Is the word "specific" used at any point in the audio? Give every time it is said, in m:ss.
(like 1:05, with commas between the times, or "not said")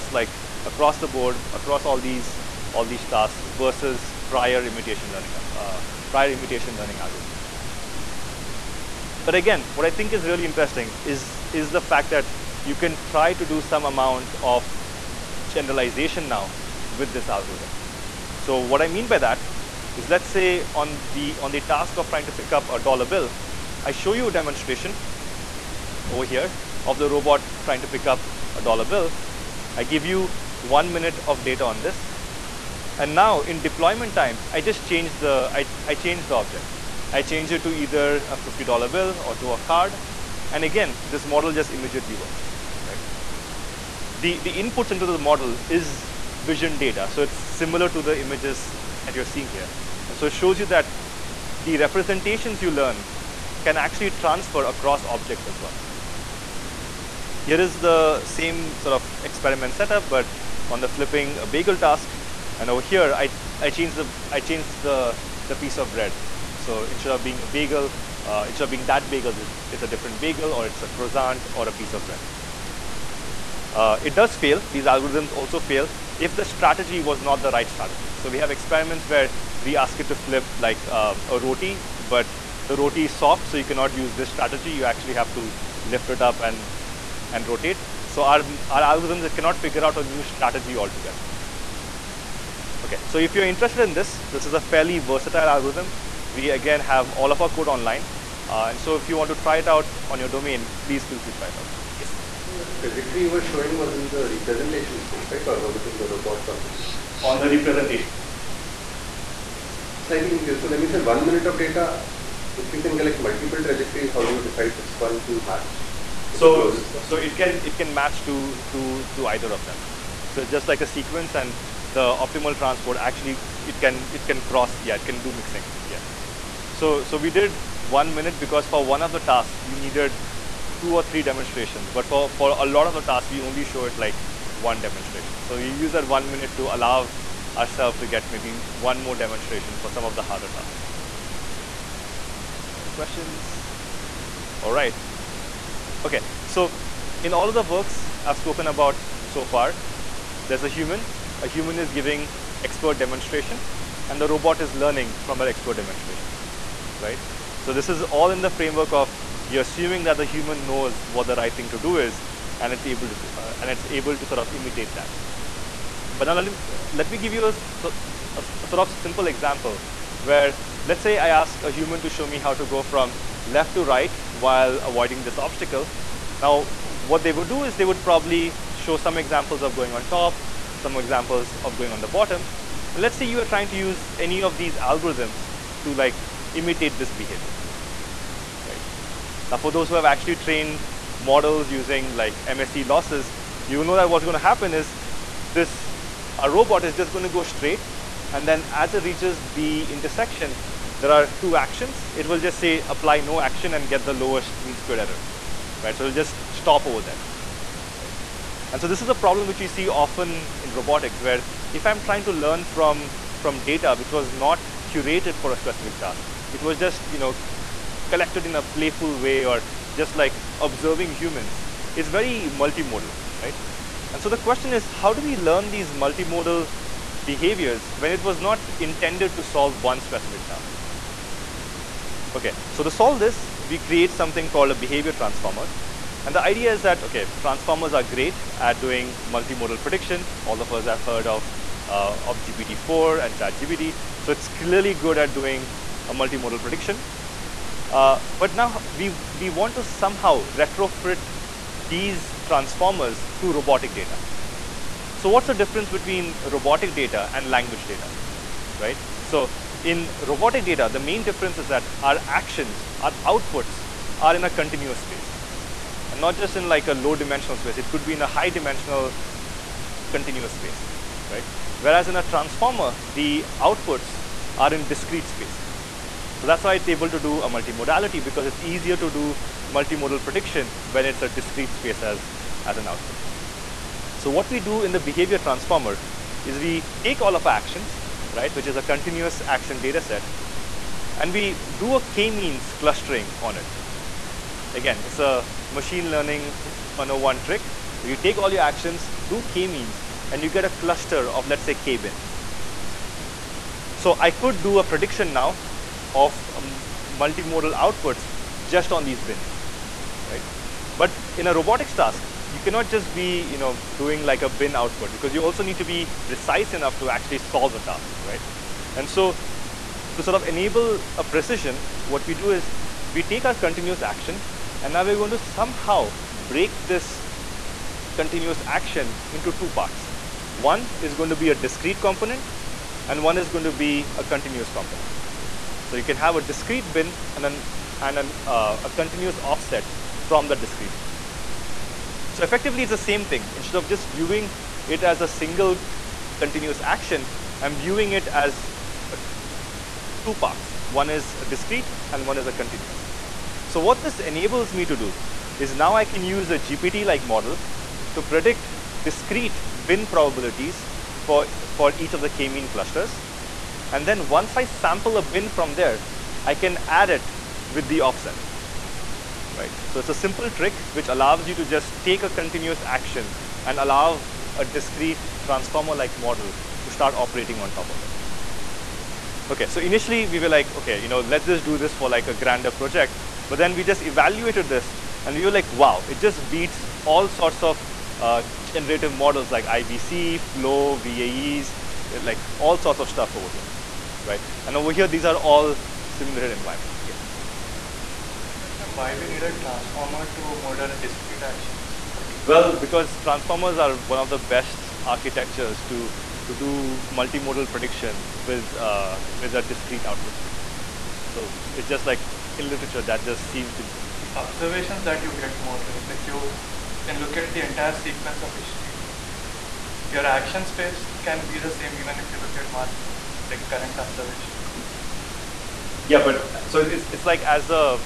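3:35, 3:50.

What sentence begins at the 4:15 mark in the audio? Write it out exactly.
So what's the difference between robotic data and language data, right?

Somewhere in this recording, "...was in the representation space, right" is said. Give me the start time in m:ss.
1:43.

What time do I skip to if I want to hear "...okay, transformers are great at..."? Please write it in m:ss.
3:57.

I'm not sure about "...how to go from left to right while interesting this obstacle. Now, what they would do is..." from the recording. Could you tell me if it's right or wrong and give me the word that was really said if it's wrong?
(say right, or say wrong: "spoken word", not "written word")
wrong: "avoiding", not "interesting".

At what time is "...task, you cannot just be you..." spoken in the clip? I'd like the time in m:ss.
5:11.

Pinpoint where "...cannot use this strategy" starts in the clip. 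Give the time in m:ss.
1:23.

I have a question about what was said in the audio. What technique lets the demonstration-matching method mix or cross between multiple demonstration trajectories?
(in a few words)
optimal transport.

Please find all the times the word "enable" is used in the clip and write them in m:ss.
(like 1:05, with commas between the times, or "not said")
5:20, 5:54.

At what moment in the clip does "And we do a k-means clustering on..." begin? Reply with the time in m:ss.
4:51.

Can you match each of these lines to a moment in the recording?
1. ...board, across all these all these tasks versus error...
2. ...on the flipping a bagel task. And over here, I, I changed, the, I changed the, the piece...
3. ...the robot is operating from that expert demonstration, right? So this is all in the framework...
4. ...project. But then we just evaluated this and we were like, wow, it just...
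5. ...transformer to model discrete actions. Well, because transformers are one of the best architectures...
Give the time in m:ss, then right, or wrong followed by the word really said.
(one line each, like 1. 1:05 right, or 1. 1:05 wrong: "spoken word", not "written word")
1. 0:01 wrong: "prior", not "error"
2. 1:00 right
3. 2:34 wrong: "learning", not "operating"
4. 6:22 right
5. 6:39 right.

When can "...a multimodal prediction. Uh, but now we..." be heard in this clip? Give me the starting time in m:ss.
4:06.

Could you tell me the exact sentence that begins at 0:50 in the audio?
And so it shows you that the representations you learn can actually transfer across objects as well.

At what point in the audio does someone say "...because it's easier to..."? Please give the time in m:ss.
4:38.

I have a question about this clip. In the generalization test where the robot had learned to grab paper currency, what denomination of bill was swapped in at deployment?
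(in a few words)
$50.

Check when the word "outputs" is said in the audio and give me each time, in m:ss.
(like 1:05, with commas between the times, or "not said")
4:23, 4:33, 4:42, 5:07, 5:14, 6:50.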